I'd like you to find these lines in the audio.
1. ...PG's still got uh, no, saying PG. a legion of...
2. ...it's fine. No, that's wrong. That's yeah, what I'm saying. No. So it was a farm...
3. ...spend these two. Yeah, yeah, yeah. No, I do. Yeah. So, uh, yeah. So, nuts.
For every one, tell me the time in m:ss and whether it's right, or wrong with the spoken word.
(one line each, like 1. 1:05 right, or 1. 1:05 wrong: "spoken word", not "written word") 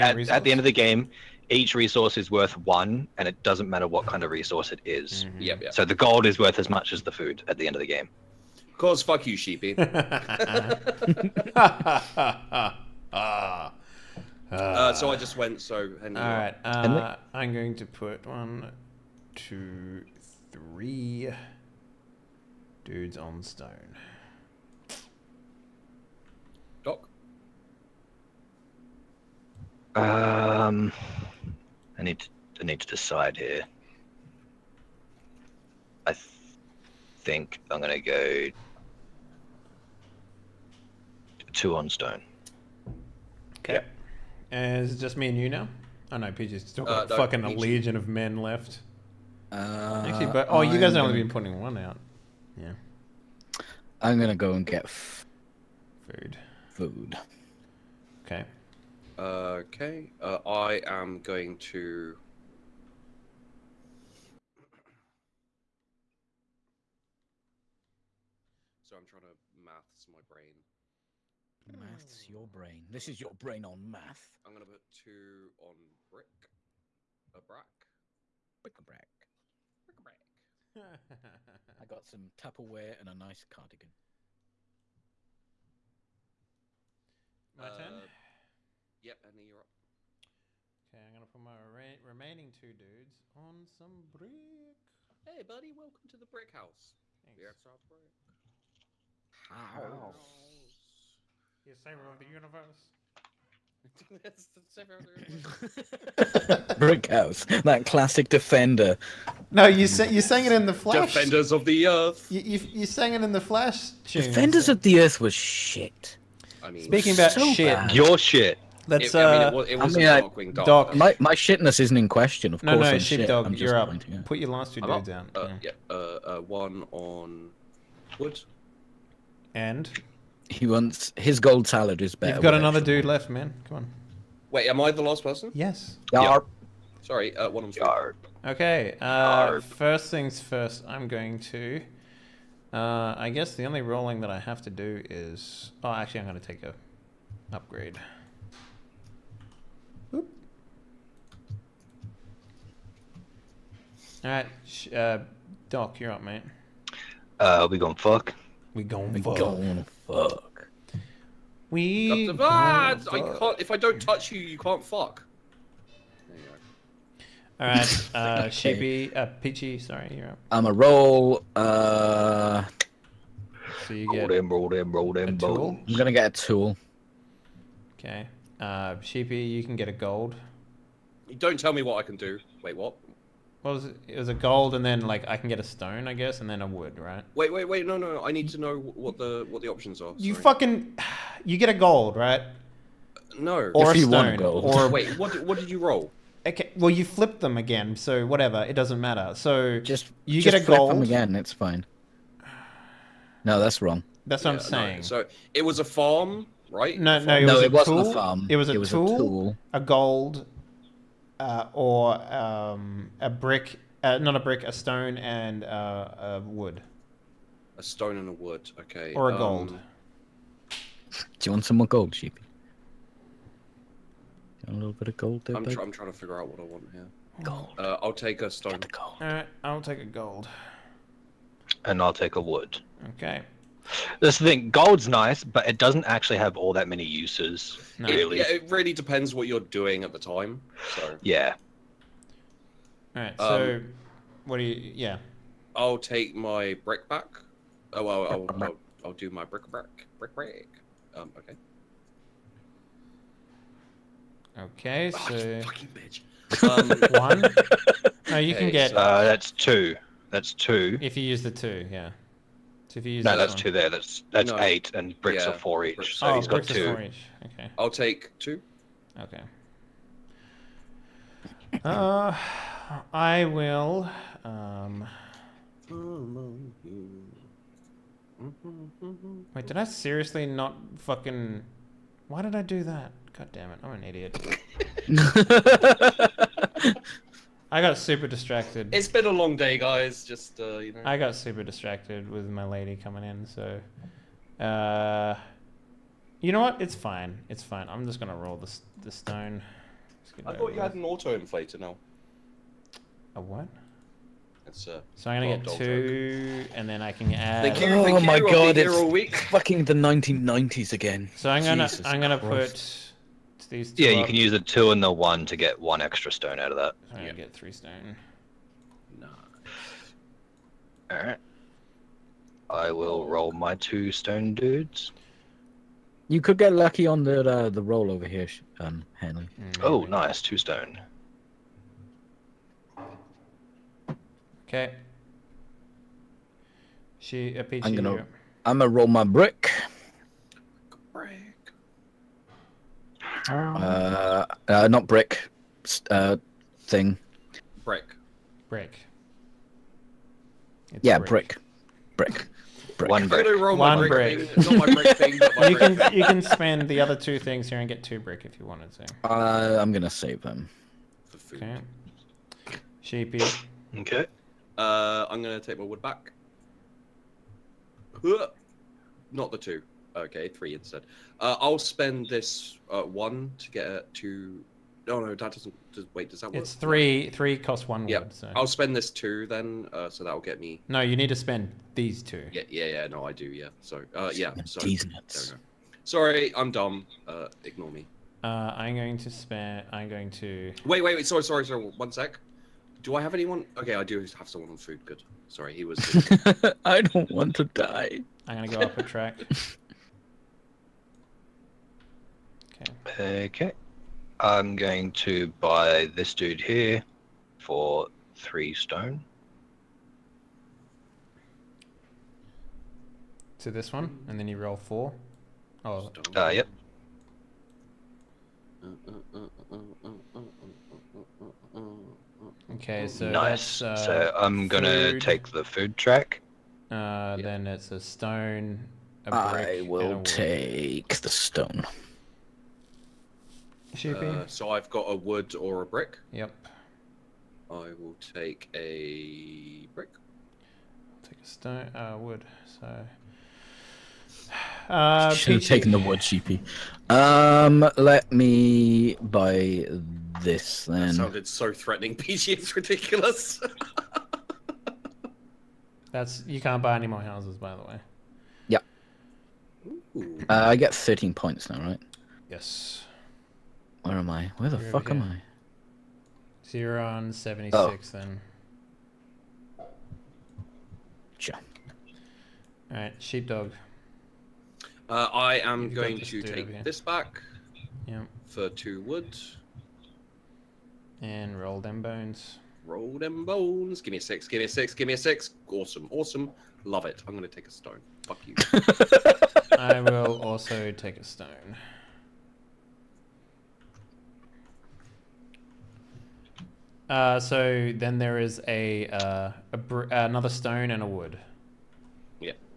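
1. 0:46 wrong: "fucking", not "saying"
2. 3:21 right
3. 6:21 right.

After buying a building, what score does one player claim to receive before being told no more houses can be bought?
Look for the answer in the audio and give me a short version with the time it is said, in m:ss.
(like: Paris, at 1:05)
13 points, at 7:40.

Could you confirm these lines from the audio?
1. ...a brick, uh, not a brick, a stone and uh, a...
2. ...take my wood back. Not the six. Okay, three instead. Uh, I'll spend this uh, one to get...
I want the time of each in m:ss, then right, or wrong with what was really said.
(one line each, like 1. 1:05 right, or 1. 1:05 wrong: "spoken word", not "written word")
1. 3:33 right
2. 6:05 wrong: "two", not "six".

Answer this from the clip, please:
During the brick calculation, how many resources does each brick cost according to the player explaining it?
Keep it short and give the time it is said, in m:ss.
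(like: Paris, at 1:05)
4, at 4:25.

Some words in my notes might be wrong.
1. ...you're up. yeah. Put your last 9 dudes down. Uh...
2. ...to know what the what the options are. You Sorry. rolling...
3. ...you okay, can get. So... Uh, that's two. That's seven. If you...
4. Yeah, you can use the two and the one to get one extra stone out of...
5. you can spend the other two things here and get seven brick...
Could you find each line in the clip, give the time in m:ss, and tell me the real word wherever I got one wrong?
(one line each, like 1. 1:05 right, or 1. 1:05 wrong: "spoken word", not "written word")
1. 2:03 wrong: "2", not "9"
2. 3:08 wrong: "fucking", not "rolling"
3. 4:18 wrong: "two", not "seven"
4. 5:14 right
5. 5:56 wrong: "two", not "seven".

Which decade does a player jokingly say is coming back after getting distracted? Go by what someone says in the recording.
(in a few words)
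The 1990s.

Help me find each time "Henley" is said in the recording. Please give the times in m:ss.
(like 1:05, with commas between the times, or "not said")
0:16, 5:29.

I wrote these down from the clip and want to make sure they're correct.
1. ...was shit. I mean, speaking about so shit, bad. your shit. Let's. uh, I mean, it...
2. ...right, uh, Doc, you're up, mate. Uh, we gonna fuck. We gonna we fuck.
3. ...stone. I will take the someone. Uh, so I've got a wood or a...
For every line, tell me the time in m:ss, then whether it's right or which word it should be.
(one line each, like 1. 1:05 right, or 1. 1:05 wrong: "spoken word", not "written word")
1. 1:55 right
2. 2:34 right
3. 7:08 wrong: "stone", not "someone".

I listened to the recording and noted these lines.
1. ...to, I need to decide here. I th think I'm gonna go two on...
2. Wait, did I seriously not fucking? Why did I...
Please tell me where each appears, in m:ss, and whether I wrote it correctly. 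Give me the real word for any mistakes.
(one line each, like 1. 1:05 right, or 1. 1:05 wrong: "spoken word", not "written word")
1. 0:32 right
2. 4:39 right.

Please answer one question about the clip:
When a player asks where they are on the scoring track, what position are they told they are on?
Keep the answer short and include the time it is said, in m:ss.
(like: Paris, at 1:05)
76, at 7:47.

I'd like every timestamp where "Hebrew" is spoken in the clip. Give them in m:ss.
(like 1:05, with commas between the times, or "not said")
not said.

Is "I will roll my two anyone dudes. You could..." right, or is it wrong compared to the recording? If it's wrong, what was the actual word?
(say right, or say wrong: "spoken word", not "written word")
wrong: "stone", not "anyone".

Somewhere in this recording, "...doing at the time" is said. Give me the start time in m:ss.
3:59.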